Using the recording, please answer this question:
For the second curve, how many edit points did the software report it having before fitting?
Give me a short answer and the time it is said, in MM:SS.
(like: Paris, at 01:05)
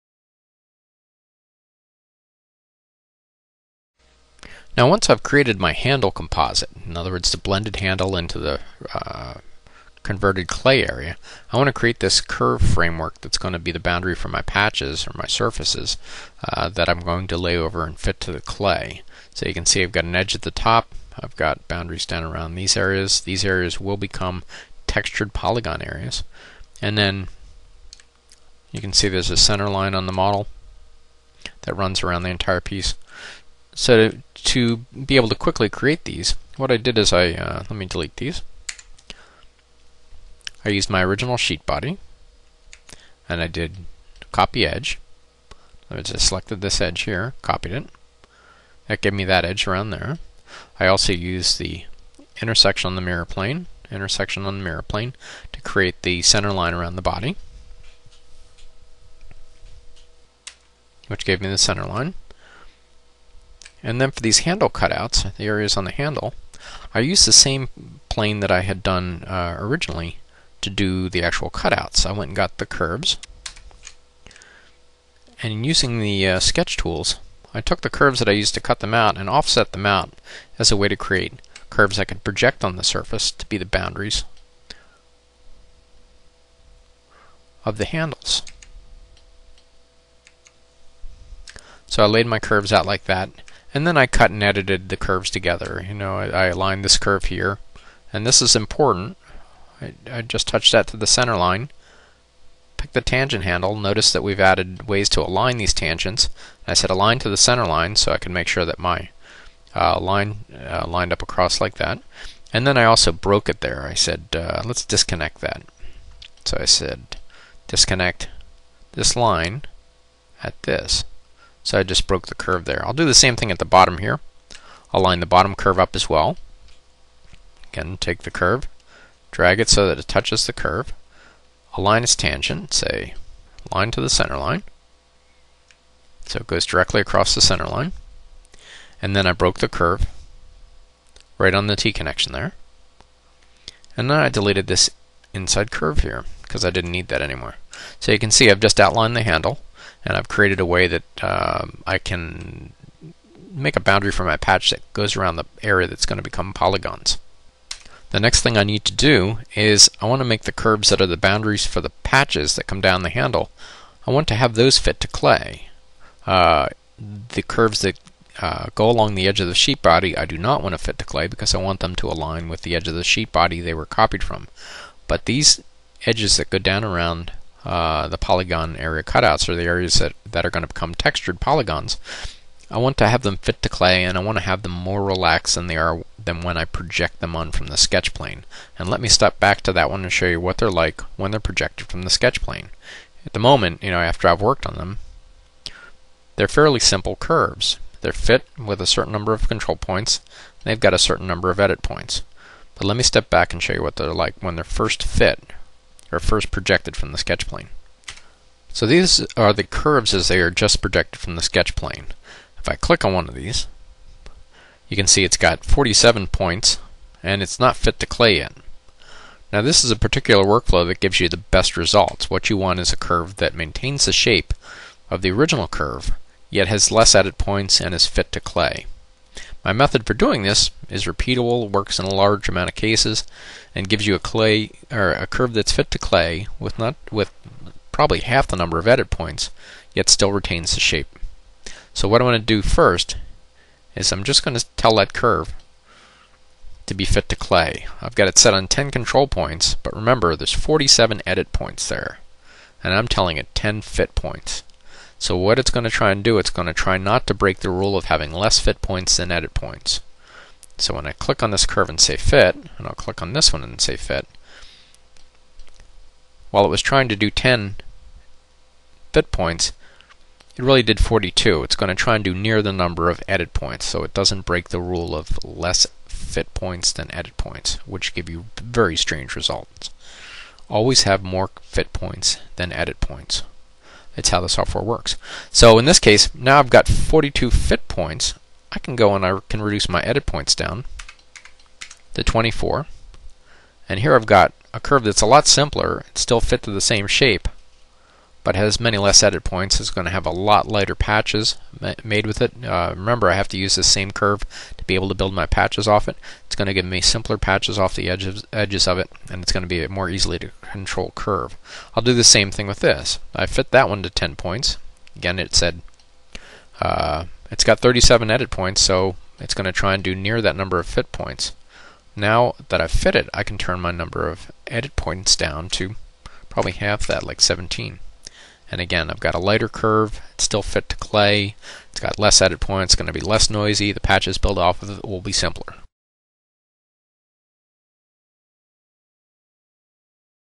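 37, at 05:17.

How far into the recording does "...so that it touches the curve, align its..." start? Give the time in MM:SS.
02:09.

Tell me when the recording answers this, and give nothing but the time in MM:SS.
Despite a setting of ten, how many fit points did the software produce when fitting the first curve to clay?
04:30.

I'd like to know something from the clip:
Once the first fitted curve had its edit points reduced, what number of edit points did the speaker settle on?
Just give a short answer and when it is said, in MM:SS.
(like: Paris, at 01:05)
24, at 04:52.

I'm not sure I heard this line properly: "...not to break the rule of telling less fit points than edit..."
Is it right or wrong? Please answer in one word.
wrong.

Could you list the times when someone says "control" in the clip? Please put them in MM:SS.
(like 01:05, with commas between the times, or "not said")
03:19, 04:08, 05:10.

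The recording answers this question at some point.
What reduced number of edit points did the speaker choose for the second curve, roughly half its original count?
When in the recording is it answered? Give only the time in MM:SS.
05:27.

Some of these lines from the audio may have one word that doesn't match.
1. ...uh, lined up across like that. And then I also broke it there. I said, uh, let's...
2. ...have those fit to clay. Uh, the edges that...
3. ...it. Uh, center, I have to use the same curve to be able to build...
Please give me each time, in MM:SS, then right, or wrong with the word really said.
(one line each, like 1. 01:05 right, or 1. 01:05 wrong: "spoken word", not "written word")
1. 01:50 right
2. 02:44 wrong: "curves", not "edges"
3. 05:02 wrong: "remember", not "center".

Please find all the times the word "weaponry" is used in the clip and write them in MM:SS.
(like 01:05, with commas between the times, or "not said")
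not said.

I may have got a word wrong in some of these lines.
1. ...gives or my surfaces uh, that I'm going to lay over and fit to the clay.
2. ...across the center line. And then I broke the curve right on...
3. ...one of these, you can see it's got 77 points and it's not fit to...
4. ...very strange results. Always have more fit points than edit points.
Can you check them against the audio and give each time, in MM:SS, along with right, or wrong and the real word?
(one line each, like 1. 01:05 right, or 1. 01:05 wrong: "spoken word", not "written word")
1. 00:14 wrong: "patches", not "gives"
2. 02:16 right
3. 03:33 wrong: "47", not "77"
4. 04:38 right.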